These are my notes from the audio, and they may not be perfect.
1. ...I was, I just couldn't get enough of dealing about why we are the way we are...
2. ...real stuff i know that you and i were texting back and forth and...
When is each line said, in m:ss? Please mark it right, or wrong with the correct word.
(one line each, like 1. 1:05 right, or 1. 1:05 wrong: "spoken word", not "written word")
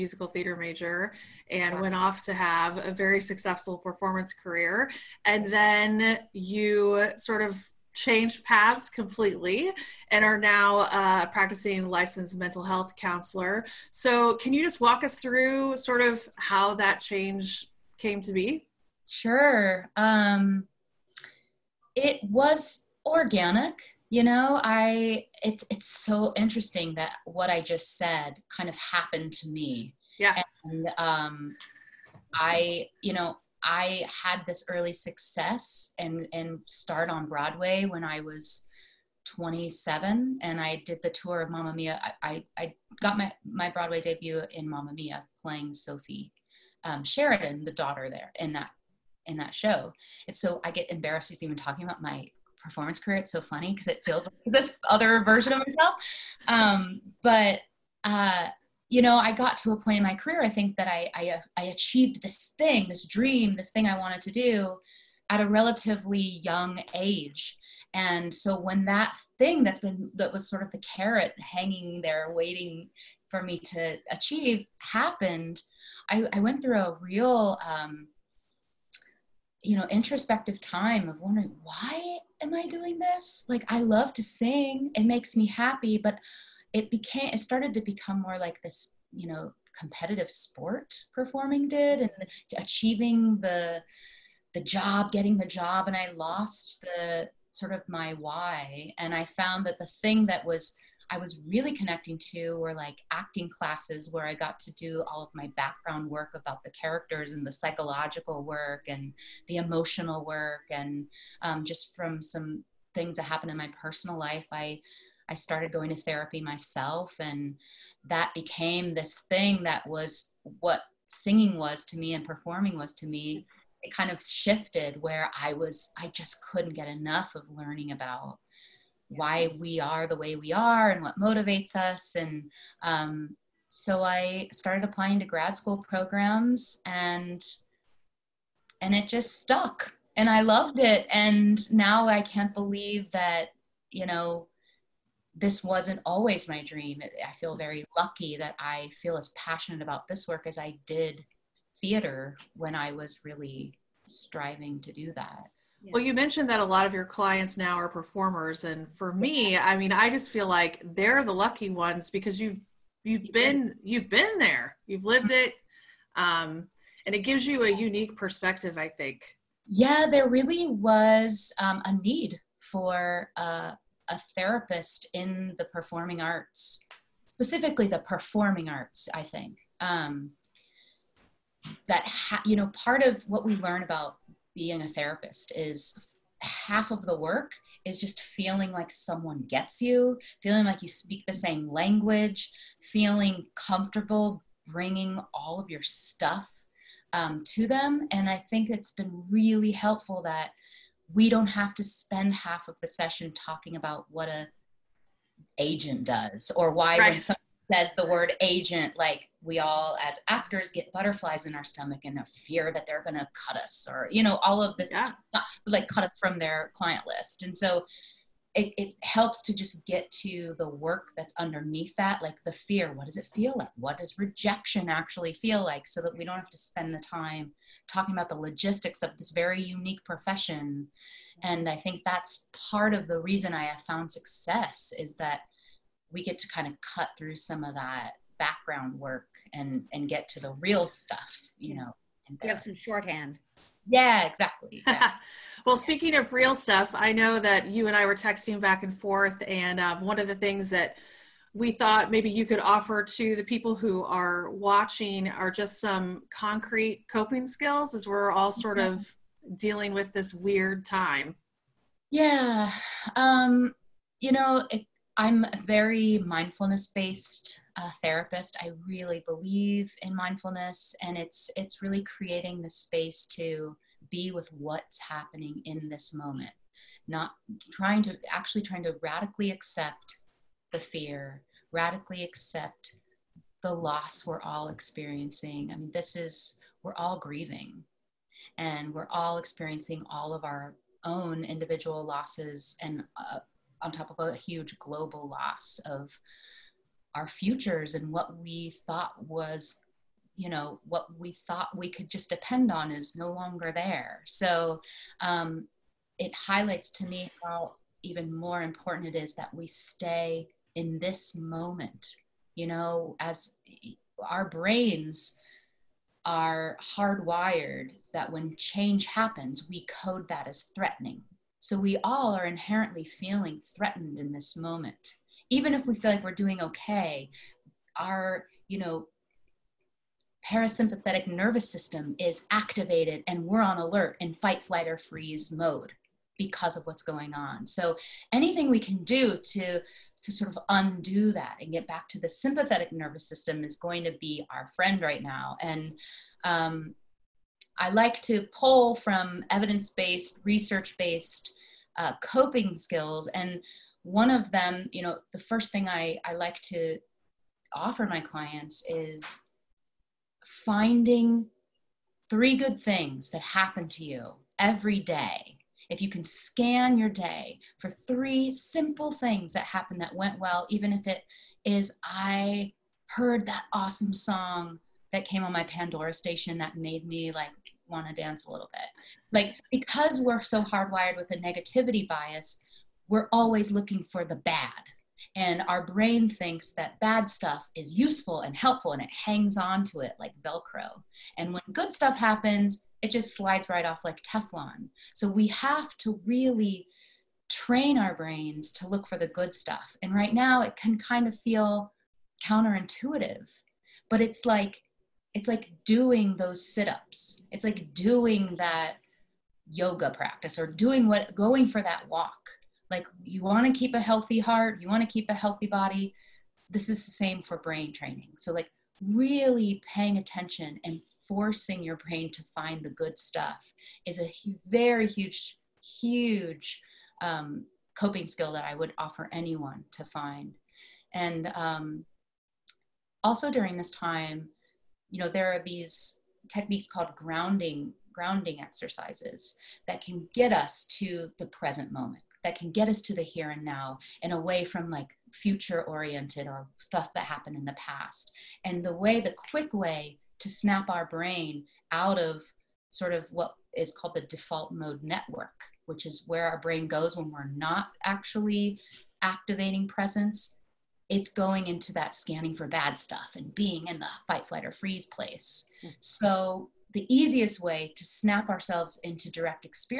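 1. 2:05 wrong: "learning", not "dealing"
2. 4:06 right.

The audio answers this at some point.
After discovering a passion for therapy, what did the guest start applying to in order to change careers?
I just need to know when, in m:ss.
2:15.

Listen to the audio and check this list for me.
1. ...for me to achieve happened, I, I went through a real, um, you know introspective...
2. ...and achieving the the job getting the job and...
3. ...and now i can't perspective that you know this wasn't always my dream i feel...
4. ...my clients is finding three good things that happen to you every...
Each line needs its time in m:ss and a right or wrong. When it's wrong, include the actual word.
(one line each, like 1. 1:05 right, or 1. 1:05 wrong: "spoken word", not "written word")
1. 1:13 right
2. 1:31 right
3. 2:21 wrong: "believe", not "perspective"
4. 5:58 right.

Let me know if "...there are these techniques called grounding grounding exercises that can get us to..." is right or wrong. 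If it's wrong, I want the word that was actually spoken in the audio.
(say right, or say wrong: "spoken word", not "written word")
right.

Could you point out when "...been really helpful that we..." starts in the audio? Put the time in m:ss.
3:18.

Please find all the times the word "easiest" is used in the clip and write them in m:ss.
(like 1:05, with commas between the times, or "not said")
7:47.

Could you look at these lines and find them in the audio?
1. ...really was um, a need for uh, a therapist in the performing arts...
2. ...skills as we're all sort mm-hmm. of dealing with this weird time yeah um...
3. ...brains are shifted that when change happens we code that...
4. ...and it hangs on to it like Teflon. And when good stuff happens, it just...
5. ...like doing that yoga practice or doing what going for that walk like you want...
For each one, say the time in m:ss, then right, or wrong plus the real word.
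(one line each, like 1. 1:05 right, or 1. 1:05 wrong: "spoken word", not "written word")
1. 2:50 right
2. 4:17 right
3. 5:14 wrong: "hardwired", not "shifted"
4. 6:28 wrong: "Velcro", not "Teflon"
5. 6:47 right.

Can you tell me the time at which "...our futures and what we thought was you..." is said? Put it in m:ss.
4:57.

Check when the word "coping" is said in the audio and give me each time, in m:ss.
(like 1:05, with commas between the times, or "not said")
4:17, 5:52, 7:07.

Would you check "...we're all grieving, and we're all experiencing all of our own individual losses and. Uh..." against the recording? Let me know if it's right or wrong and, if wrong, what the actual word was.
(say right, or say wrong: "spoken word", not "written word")
right.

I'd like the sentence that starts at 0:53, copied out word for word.
It's so funny because it feels like this other version of myself.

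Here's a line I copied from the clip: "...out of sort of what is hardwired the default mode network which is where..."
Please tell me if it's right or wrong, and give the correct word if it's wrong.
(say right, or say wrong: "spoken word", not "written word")
wrong: "called", not "hardwired".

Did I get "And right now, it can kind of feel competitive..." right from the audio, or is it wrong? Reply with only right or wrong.
wrong.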